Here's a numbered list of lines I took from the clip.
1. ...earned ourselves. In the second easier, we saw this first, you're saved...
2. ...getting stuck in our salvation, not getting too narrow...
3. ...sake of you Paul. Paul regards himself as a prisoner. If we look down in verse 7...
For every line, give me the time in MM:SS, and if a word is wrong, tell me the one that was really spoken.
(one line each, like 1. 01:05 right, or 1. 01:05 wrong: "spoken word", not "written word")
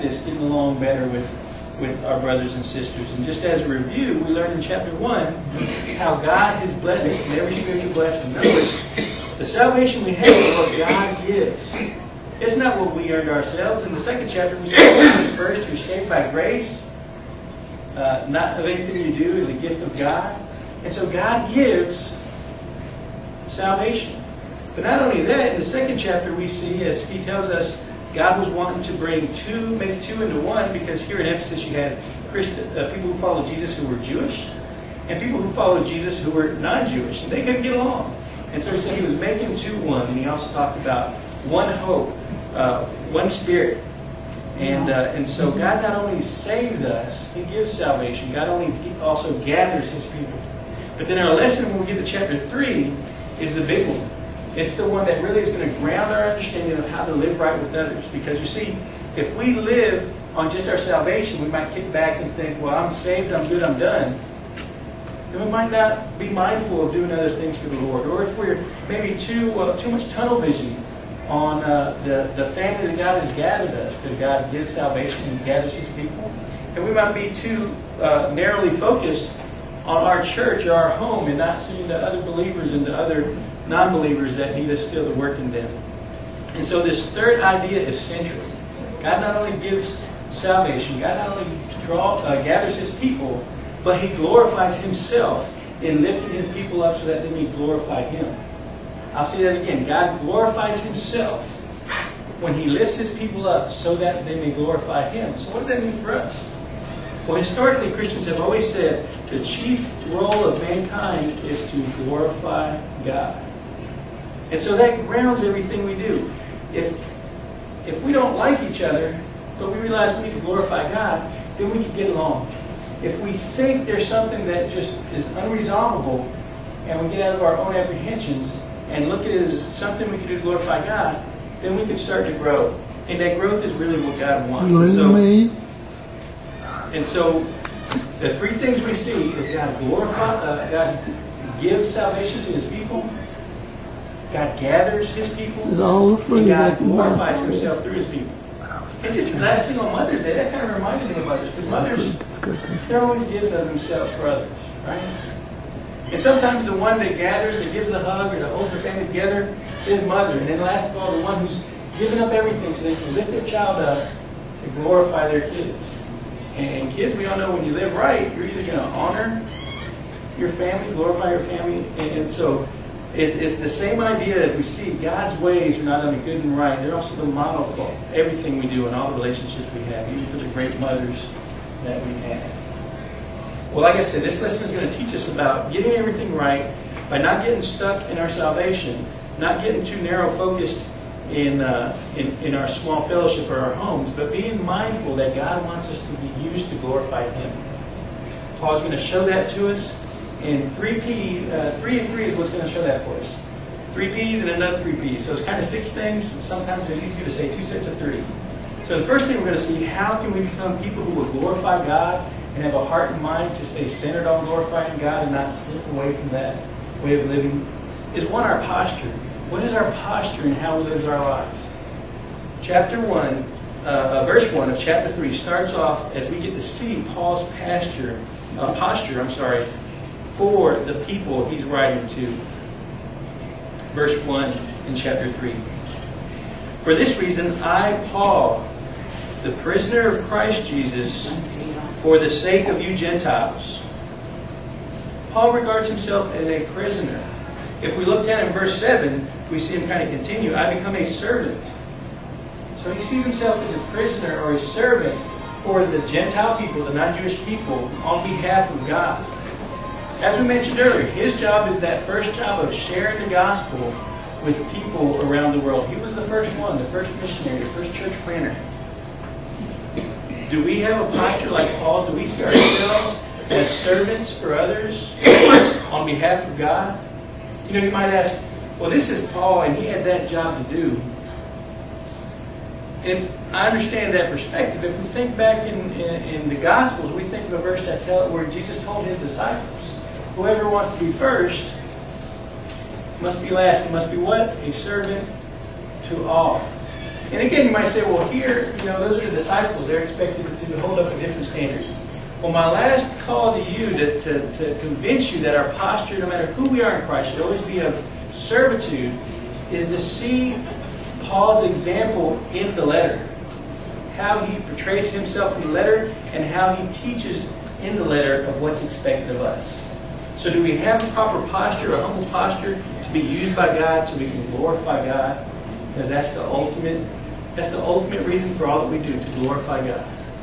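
1. 00:13 wrong: "chapter", not "easier"
2. 03:07 right
3. 04:02 wrong: "Gentiles", not "Paul".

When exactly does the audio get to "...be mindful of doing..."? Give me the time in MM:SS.
01:06.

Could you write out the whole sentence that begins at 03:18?
Paul's going to show that to us and 3P, uh, 3 and 3 is what's going to show that for us.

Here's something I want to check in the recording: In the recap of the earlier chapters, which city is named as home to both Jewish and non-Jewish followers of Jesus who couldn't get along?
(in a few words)
Ephesus.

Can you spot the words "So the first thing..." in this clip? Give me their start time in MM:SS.
03:28.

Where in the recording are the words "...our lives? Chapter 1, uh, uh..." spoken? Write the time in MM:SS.
03:41.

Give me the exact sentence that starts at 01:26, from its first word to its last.
And so this third idea is central.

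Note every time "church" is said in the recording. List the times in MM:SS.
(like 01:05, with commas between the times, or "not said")
01:20, 04:27.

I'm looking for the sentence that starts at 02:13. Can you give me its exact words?
And that growth is really what God wants.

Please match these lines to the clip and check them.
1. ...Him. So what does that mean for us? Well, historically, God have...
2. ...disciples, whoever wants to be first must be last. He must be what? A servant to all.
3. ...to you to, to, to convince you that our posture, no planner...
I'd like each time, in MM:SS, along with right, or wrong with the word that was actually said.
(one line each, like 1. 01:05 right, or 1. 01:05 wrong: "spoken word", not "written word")
1. 01:45 wrong: "Christians", not "God"
2. 04:49 right
3. 05:03 wrong: "matter", not "planner".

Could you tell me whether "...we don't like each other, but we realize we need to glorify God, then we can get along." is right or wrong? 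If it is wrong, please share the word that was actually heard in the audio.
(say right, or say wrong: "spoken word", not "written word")
right.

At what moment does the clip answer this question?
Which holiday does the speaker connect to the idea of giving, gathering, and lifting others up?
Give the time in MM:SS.
02:29.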